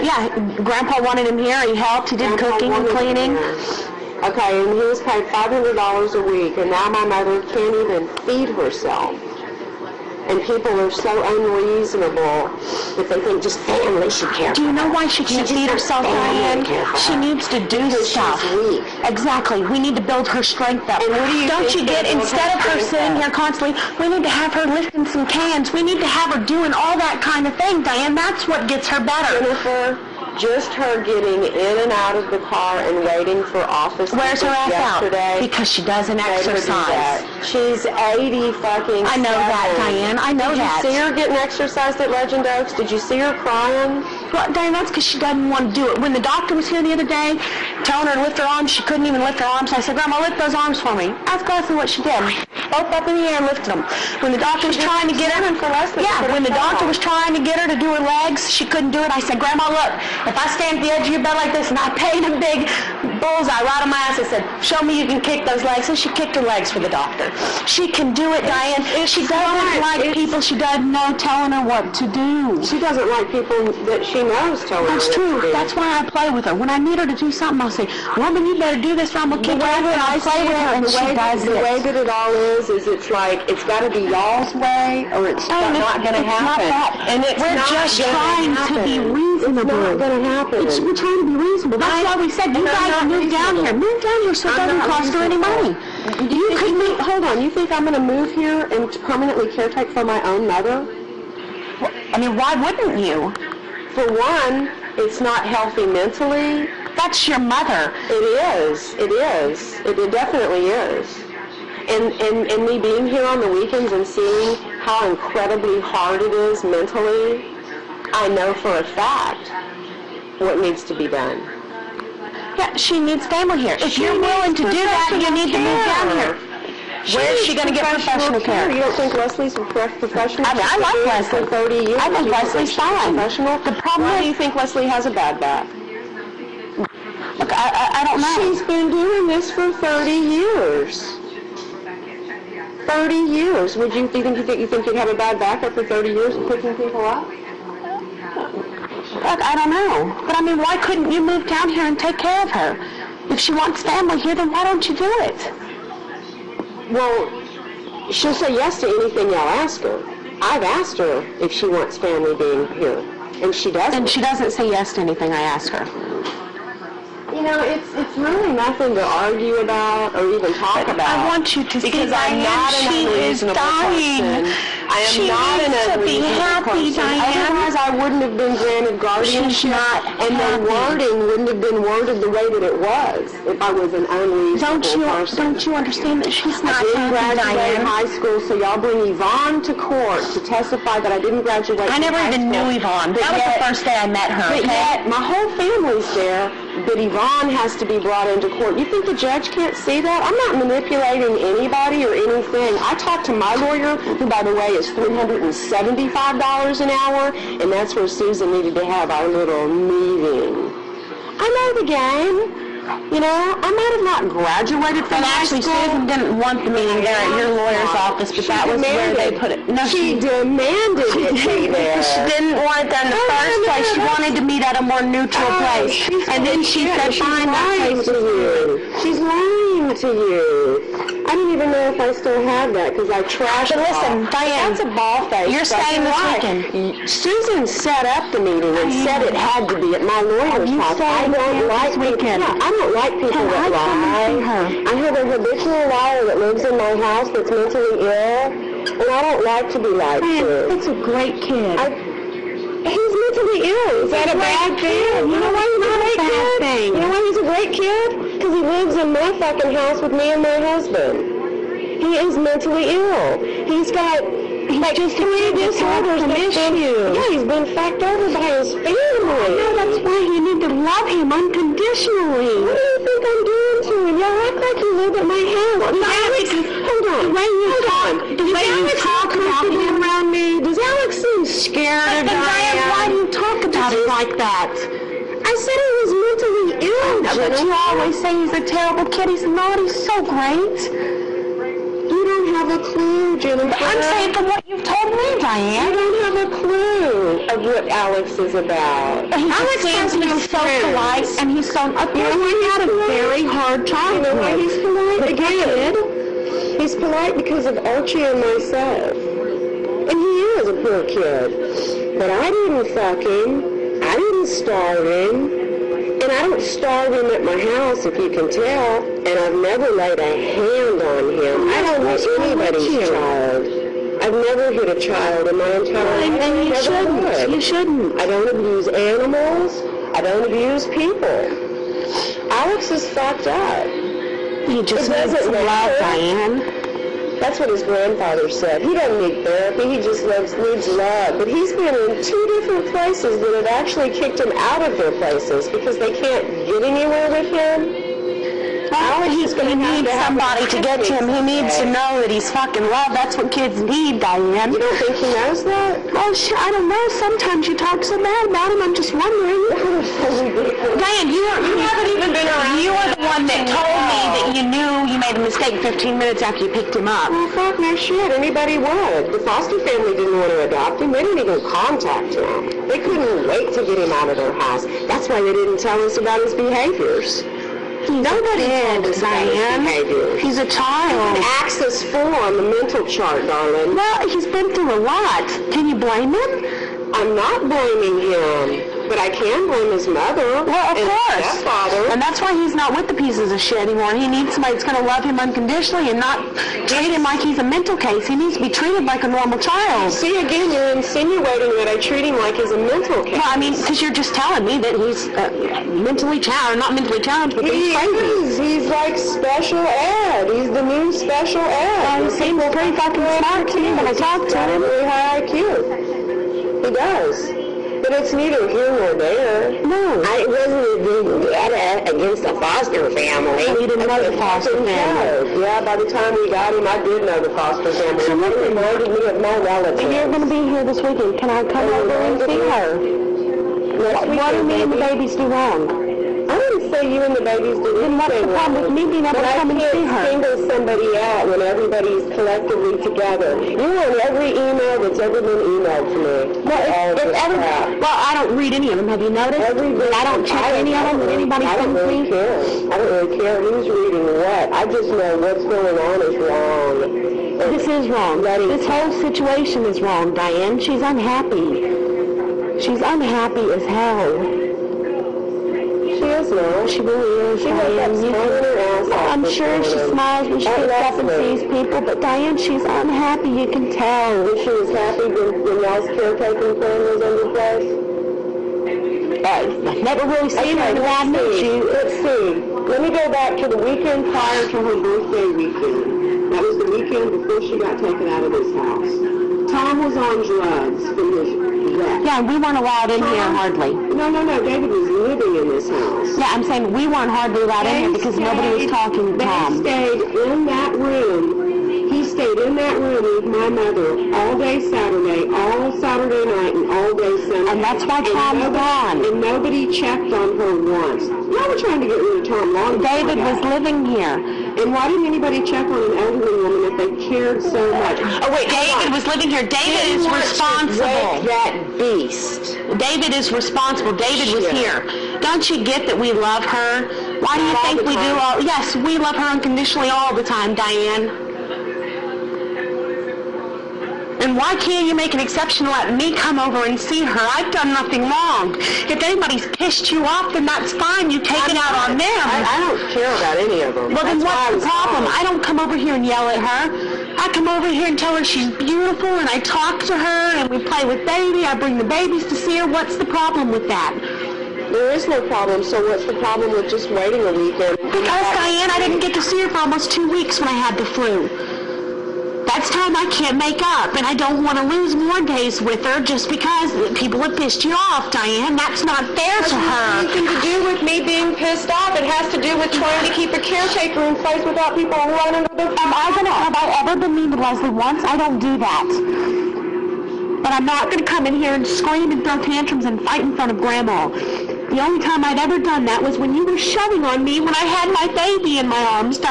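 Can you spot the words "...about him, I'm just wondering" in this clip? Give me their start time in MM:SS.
05:58.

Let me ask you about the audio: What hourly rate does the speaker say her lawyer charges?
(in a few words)
$375.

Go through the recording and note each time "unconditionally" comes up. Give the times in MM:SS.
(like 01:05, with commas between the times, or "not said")
04:31, 06:35, 08:49.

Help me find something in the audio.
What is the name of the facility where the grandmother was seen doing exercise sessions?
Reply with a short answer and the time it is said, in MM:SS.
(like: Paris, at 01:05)
Legend Oaks, at 00:42.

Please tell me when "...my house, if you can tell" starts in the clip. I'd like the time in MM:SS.
05:17.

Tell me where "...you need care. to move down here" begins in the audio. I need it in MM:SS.
02:05.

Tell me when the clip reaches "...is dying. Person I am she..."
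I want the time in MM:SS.
02:53.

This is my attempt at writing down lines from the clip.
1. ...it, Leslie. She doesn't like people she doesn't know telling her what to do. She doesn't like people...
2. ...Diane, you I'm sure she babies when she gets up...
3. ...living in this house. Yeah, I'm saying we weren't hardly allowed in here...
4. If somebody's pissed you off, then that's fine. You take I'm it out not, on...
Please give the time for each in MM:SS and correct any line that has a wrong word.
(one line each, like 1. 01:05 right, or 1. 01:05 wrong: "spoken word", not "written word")
1. 01:08 wrong: "Diane", not "Leslie"
2. 07:47 wrong: "smiles", not "babies"
3. 08:15 right
4. 08:58 wrong: "anybody", not "somebody".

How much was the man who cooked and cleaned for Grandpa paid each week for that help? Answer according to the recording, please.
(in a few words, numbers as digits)
$500.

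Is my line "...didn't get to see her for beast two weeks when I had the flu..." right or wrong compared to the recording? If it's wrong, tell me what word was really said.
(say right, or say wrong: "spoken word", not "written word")
wrong: "almost", not "beast".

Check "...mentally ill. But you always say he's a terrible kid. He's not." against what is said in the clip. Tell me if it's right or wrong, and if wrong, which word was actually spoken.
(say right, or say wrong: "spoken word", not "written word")
right.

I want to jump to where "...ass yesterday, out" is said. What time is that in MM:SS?
00:34.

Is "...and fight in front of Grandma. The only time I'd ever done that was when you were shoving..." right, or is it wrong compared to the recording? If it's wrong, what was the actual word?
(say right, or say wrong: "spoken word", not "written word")
right.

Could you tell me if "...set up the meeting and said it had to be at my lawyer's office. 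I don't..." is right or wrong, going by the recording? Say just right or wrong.
right.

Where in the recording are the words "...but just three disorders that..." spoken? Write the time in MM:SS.
04:24.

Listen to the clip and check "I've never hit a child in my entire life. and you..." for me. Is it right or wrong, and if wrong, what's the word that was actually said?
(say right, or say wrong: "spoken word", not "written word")
right.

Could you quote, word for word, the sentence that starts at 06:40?
See, again, you're insinuating that I treat him like he's a mental case.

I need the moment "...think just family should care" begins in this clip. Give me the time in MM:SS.
00:13.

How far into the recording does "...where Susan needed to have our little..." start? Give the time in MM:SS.
03:27.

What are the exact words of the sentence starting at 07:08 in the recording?
So they reminded me of my relatives.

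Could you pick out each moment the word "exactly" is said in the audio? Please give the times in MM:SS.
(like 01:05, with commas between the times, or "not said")
00:19, 00:51.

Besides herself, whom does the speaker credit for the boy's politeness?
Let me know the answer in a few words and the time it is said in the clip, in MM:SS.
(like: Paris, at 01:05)
Archie, at 05:07.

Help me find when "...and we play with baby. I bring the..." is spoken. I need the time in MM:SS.
09:10.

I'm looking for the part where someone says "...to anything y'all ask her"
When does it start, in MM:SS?
02:38.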